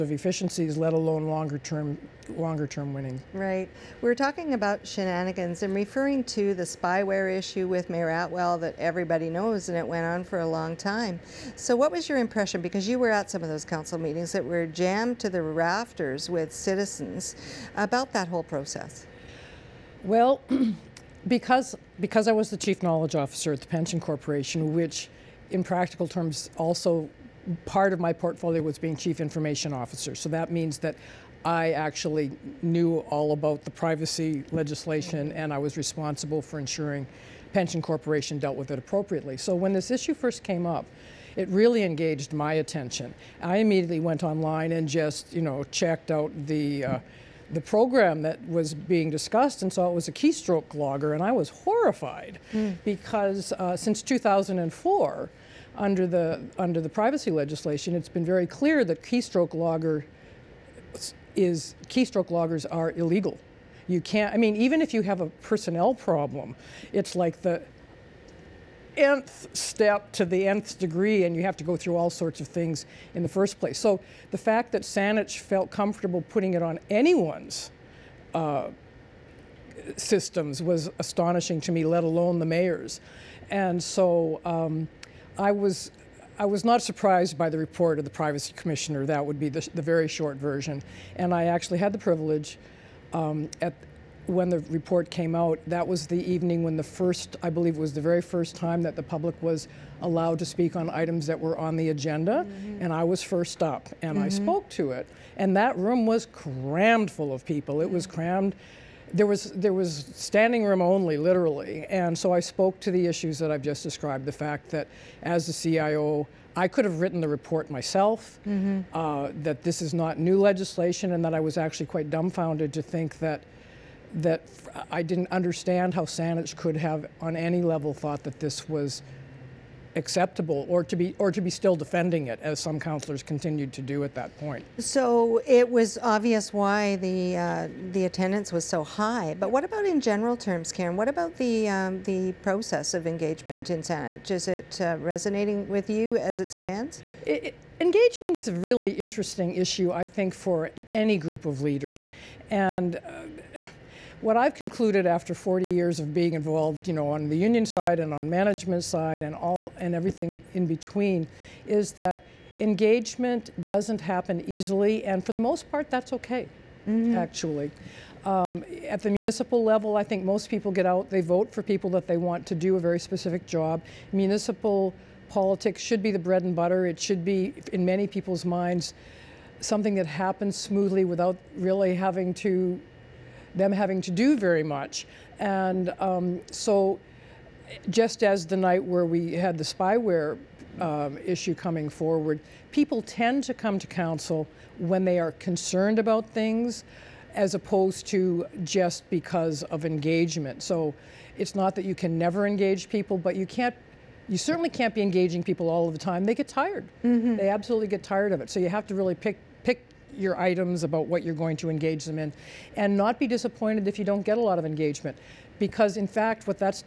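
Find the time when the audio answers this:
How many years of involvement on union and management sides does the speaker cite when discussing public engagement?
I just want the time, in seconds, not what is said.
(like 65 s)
155 s.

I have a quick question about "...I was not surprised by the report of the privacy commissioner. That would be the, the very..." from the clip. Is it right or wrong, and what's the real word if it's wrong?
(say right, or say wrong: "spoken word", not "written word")
right.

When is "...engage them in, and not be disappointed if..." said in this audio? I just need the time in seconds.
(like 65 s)
211 s.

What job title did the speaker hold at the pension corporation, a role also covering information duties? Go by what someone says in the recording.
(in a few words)
Chief knowledge officer.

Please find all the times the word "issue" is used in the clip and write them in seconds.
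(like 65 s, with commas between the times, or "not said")
7 s, 39 s, 113 s, 149 s, 191 s.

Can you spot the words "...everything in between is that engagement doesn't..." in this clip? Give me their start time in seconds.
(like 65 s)
159 s.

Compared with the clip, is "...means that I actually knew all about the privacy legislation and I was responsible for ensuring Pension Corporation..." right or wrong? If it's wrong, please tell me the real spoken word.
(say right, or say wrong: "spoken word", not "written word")
right.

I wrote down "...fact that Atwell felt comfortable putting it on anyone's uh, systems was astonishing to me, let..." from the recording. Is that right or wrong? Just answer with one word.
wrong.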